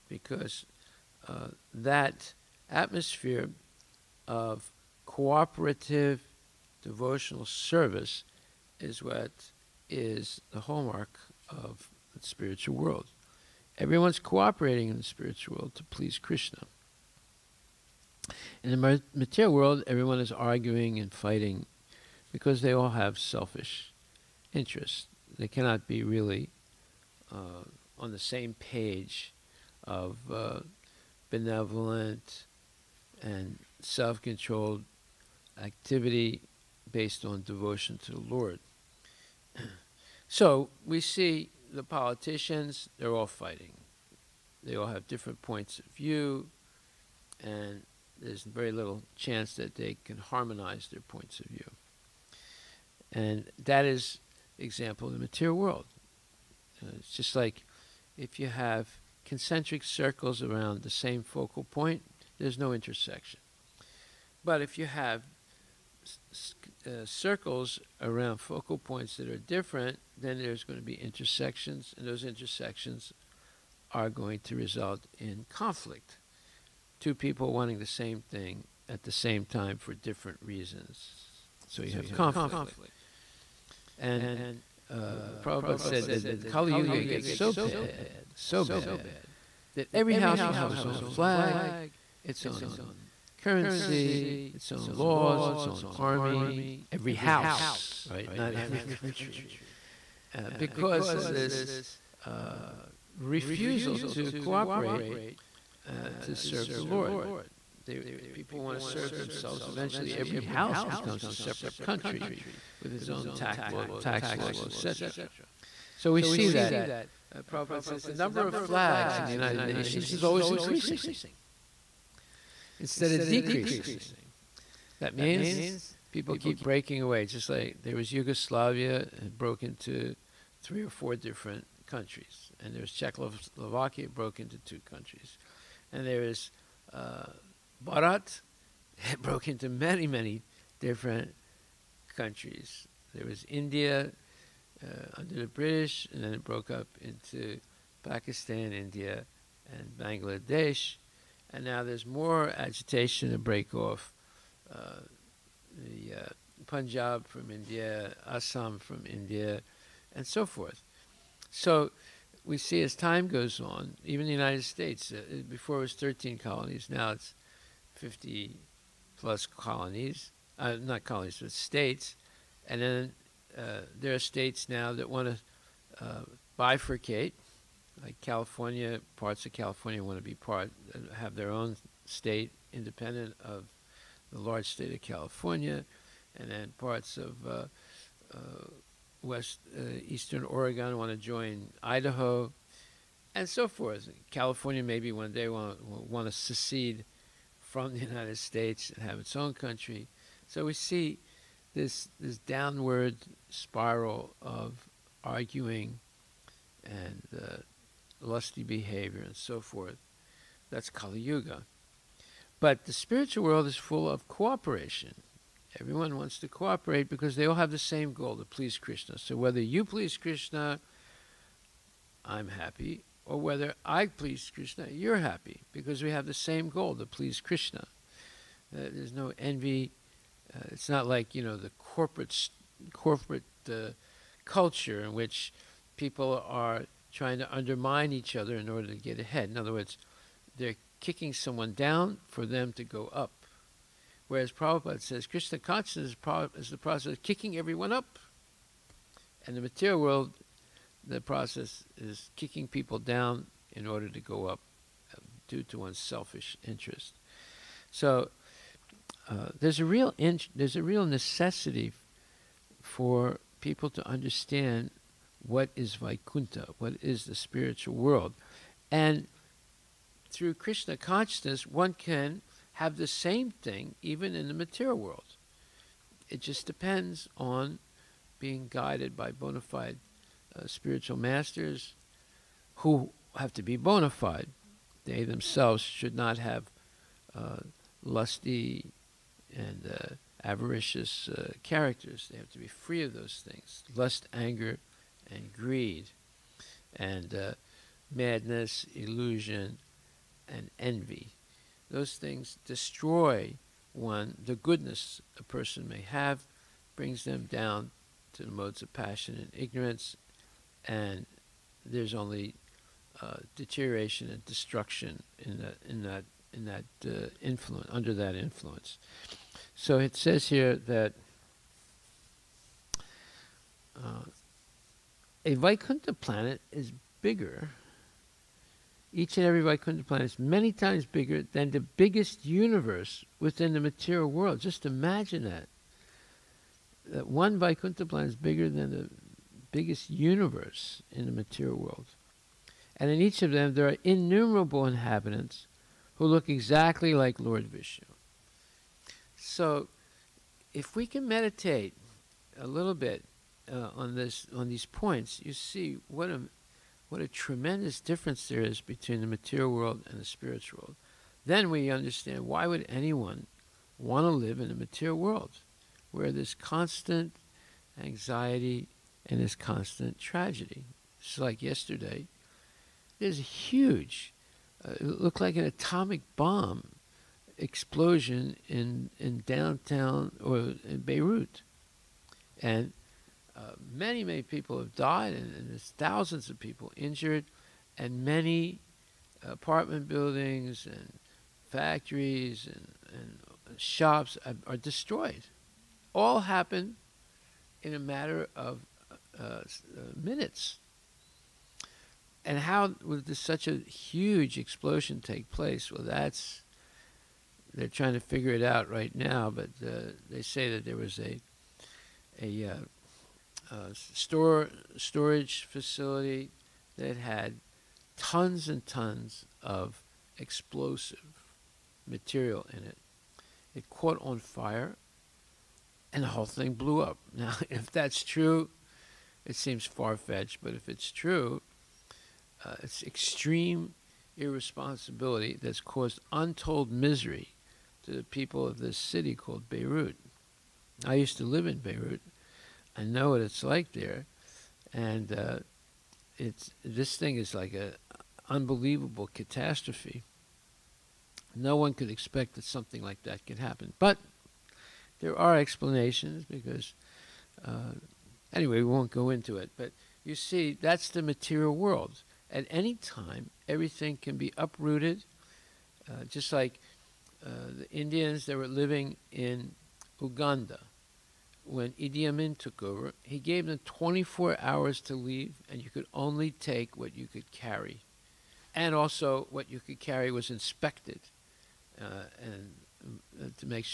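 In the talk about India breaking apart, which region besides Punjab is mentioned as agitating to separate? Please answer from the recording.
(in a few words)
Assam.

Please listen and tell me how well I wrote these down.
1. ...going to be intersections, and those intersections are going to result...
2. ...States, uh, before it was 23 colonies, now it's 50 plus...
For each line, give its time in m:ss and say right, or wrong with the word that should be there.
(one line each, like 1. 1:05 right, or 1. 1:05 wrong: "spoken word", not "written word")
1. 1:10 right
2. 2:44 wrong: "13", not "23".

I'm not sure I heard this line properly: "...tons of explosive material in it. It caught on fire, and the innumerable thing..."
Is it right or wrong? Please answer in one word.
wrong.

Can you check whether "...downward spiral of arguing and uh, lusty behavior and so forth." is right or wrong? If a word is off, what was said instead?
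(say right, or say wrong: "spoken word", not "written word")
right.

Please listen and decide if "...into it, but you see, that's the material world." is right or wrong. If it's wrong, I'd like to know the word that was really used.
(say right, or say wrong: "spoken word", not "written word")
right.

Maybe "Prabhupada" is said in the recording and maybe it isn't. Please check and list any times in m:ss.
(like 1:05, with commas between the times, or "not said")
1:25, 1:57, 4:04.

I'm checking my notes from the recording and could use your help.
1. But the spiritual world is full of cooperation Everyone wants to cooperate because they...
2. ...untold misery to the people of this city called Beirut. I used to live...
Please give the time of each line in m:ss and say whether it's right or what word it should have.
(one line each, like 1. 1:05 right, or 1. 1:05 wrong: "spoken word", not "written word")
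1. 3:32 right
2. 7:16 right.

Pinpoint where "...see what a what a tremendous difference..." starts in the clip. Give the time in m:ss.
5:55.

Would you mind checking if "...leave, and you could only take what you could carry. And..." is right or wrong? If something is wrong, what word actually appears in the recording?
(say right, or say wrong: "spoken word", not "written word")
right.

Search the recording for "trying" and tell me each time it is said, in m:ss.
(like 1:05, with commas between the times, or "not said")
3:57, 6:47.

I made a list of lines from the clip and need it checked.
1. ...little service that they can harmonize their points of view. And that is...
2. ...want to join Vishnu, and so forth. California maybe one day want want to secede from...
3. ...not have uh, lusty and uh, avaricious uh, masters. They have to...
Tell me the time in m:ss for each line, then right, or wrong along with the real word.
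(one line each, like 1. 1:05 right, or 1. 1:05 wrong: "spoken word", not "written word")
1. 0:48 wrong: "chance", not "service"
2. 3:10 wrong: "Idaho", not "Vishnu"
3. 4:46 wrong: "characters", not "masters".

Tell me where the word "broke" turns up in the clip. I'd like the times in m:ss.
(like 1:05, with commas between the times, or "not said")
2:09, 2:14, 2:19, 2:26.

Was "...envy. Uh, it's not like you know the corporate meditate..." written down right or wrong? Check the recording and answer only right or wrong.
wrong.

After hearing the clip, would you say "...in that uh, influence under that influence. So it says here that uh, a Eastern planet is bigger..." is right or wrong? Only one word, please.
wrong.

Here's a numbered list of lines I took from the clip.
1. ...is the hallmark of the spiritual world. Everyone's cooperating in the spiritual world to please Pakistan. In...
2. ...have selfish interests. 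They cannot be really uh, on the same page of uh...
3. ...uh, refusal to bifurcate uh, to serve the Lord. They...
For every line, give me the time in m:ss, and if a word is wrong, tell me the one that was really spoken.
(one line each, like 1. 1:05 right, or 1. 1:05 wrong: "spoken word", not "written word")
1. 0:09 wrong: "Krishna", not "Pakistan"
2. 0:22 right
3. 1:42 wrong: "cooperate", not "bifurcate".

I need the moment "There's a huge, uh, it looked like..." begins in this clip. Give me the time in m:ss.
6:13.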